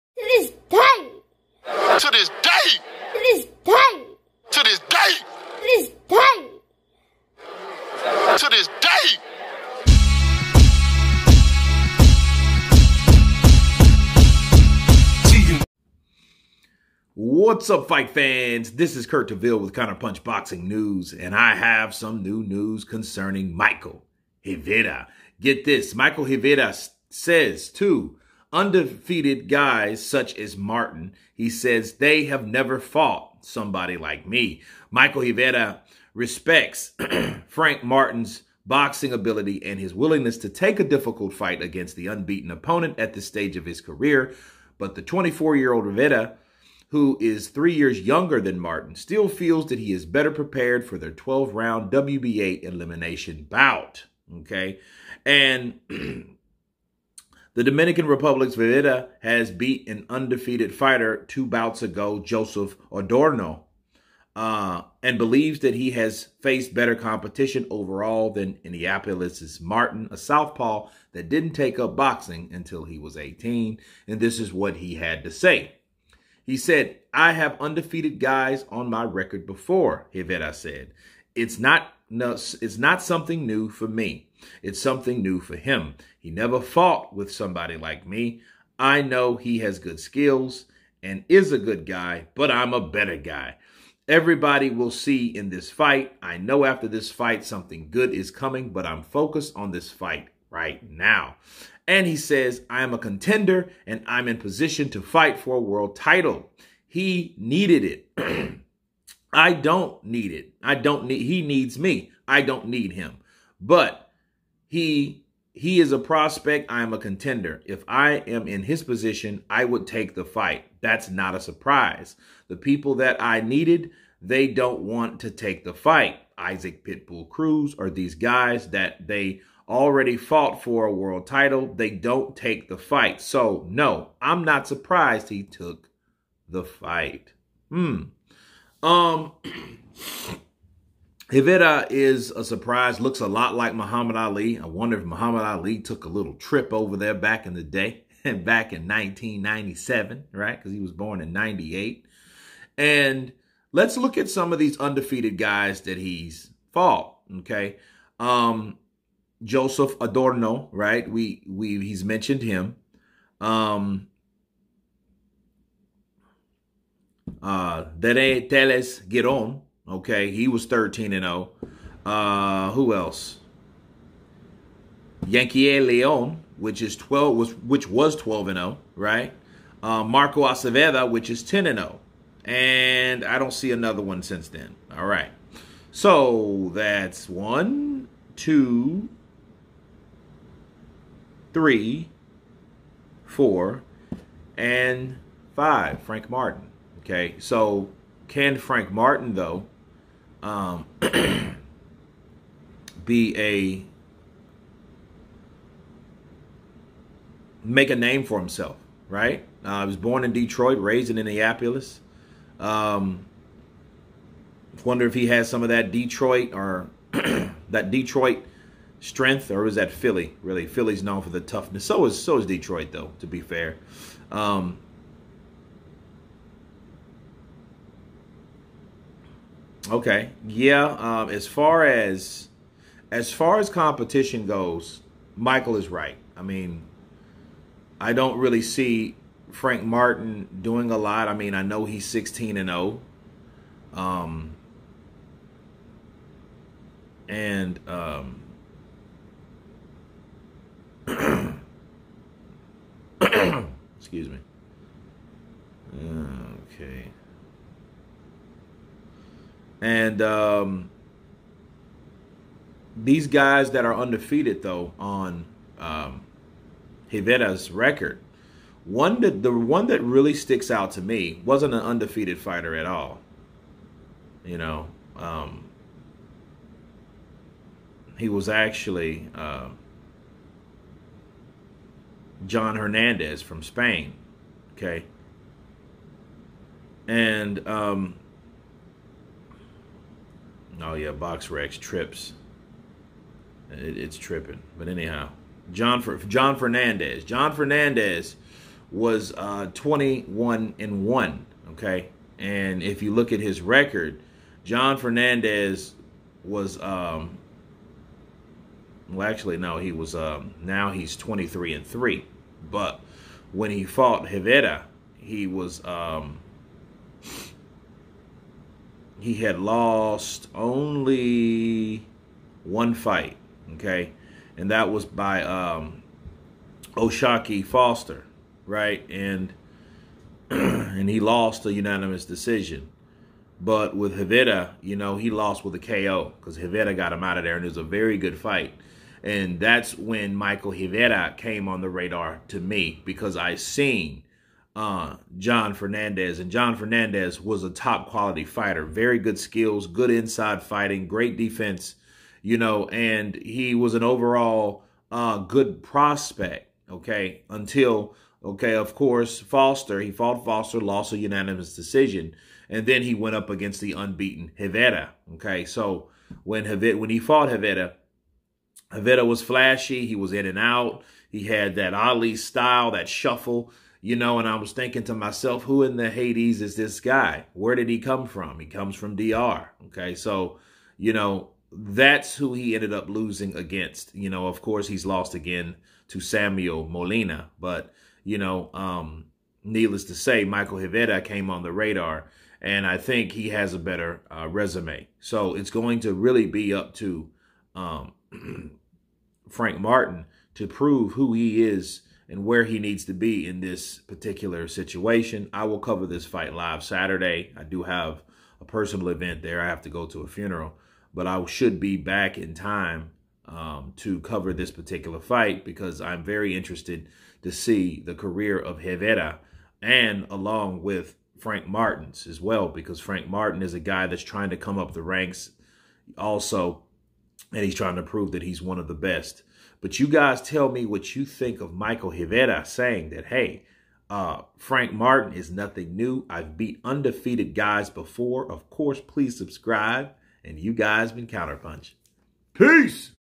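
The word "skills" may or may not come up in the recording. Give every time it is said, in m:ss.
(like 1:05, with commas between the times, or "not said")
1:29, 5:49.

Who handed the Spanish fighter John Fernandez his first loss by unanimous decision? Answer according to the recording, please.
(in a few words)
Oshaki Foster.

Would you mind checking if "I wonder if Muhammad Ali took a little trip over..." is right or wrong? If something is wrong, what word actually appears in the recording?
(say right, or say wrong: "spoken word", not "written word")
right.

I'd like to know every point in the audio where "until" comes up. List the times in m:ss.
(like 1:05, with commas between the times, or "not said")
1:12, 5:57.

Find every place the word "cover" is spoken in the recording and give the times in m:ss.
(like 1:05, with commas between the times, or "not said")
6:45, 6:54.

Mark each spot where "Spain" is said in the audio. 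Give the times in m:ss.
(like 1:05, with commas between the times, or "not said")
4:43.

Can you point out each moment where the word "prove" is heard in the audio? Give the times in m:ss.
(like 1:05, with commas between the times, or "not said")
6:40, 7:08.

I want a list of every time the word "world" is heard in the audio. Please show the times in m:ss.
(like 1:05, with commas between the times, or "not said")
1:45, 2:10.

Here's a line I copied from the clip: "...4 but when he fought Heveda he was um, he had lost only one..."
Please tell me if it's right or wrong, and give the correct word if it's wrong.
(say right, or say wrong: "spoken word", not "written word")
wrong: "3", not "4".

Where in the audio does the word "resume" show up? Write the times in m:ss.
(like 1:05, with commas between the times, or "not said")
6:34.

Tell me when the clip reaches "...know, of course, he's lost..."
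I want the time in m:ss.
6:24.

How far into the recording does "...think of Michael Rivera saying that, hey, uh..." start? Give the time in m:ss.
7:11.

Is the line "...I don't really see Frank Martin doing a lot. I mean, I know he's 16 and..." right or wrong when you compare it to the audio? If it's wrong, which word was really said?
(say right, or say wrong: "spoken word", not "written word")
right.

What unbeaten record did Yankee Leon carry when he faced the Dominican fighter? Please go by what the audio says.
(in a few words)
12-0.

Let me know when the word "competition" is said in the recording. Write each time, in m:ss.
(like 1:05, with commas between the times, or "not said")
1:06, 3:53.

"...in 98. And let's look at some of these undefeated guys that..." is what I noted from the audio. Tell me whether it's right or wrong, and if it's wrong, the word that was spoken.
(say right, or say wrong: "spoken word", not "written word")
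right.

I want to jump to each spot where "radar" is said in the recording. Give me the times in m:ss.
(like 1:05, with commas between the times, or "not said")
5:41, 6:31.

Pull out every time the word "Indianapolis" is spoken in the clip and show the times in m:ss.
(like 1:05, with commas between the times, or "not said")
1:08, 3:31.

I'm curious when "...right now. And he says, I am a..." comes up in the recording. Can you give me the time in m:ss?
1:40.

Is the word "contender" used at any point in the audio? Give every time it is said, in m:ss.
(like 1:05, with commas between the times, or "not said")
1:42, 1:56.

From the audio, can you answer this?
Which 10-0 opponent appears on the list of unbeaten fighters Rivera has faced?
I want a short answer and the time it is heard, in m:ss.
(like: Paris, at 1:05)
Marco Aceveda, at 3:00.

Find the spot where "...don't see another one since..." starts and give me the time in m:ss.
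3:03.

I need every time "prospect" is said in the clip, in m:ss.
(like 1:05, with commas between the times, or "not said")
1:55, 5:55.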